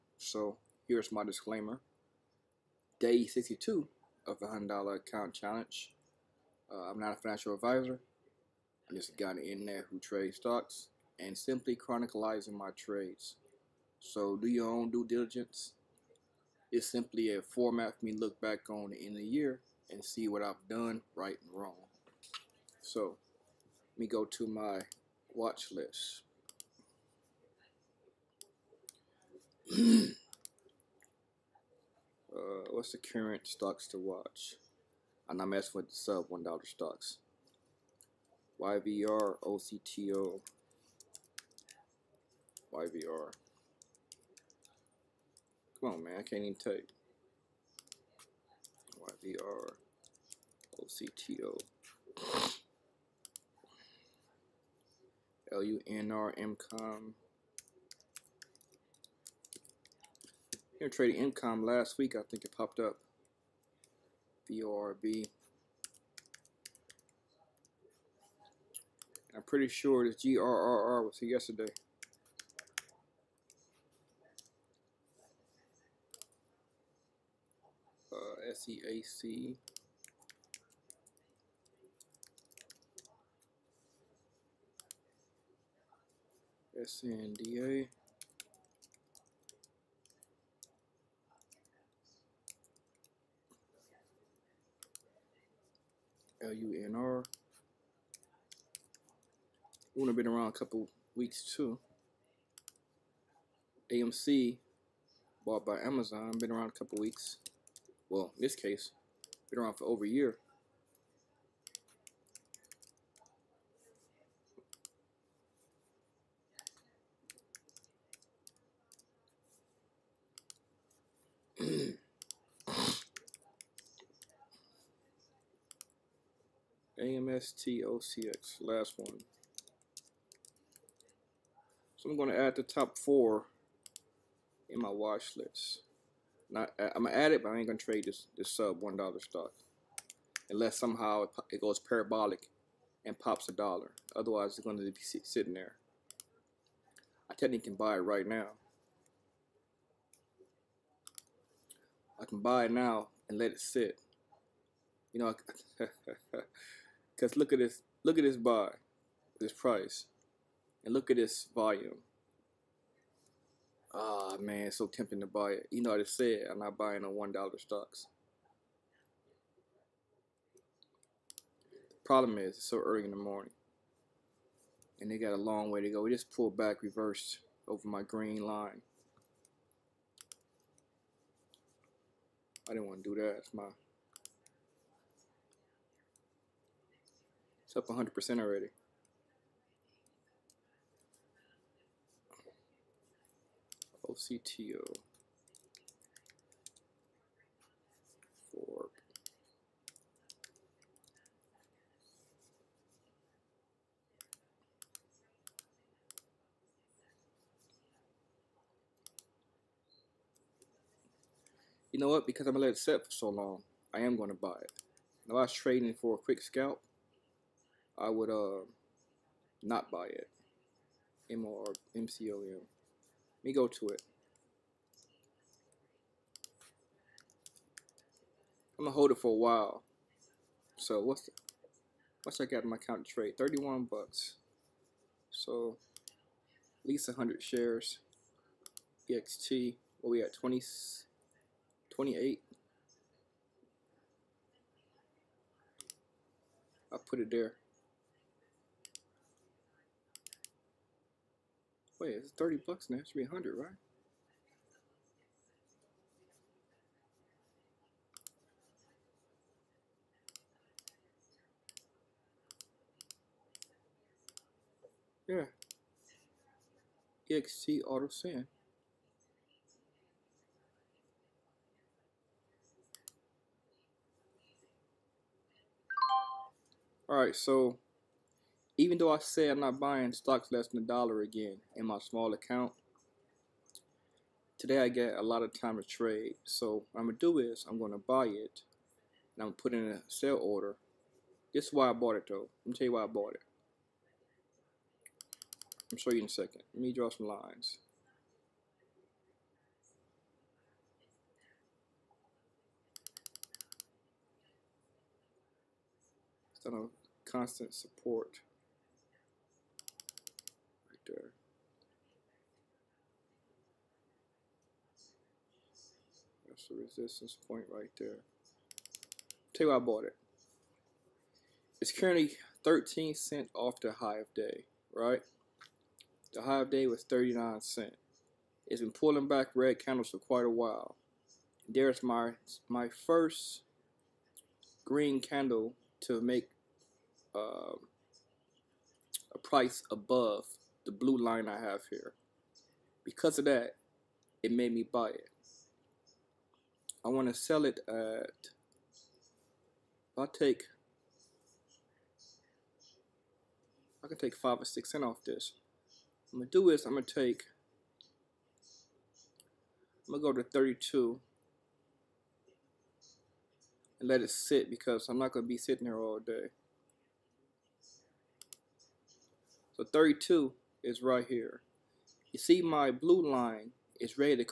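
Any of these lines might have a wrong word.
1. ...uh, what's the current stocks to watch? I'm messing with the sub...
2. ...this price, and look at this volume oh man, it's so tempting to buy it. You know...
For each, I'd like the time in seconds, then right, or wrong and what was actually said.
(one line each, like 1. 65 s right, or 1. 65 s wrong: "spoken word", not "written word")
1. 32 s right
2. 159 s right.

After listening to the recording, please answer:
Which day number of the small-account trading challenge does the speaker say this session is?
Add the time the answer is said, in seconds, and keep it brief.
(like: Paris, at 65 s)
Day 62, at 2 s.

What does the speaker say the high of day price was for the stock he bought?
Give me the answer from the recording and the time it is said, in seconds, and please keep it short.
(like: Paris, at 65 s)
39 cent, at 327 s.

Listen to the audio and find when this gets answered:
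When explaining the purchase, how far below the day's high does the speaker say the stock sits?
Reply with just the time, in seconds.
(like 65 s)
322 s.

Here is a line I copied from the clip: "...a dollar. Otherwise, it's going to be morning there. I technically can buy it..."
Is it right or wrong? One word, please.
wrong.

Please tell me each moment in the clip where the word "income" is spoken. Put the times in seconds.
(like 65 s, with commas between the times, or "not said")
61 s.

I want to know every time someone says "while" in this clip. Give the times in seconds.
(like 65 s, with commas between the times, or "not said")
229 s, 330 s.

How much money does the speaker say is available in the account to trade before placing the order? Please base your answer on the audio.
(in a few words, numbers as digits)
31 bucks.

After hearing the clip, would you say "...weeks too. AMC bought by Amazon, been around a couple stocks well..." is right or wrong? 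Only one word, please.
wrong.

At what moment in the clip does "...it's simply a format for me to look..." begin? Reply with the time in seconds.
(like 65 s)
16 s.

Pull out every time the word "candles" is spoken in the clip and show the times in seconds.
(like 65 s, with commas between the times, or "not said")
329 s, 335 s.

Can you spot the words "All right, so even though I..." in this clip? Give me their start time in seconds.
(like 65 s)
277 s.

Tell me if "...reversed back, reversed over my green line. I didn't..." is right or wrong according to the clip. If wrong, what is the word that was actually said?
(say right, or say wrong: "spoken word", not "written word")
wrong: "pulled", not "reversed".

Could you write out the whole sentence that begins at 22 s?
So let me go to my watch list.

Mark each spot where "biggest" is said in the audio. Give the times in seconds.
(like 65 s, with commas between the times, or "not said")
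not said.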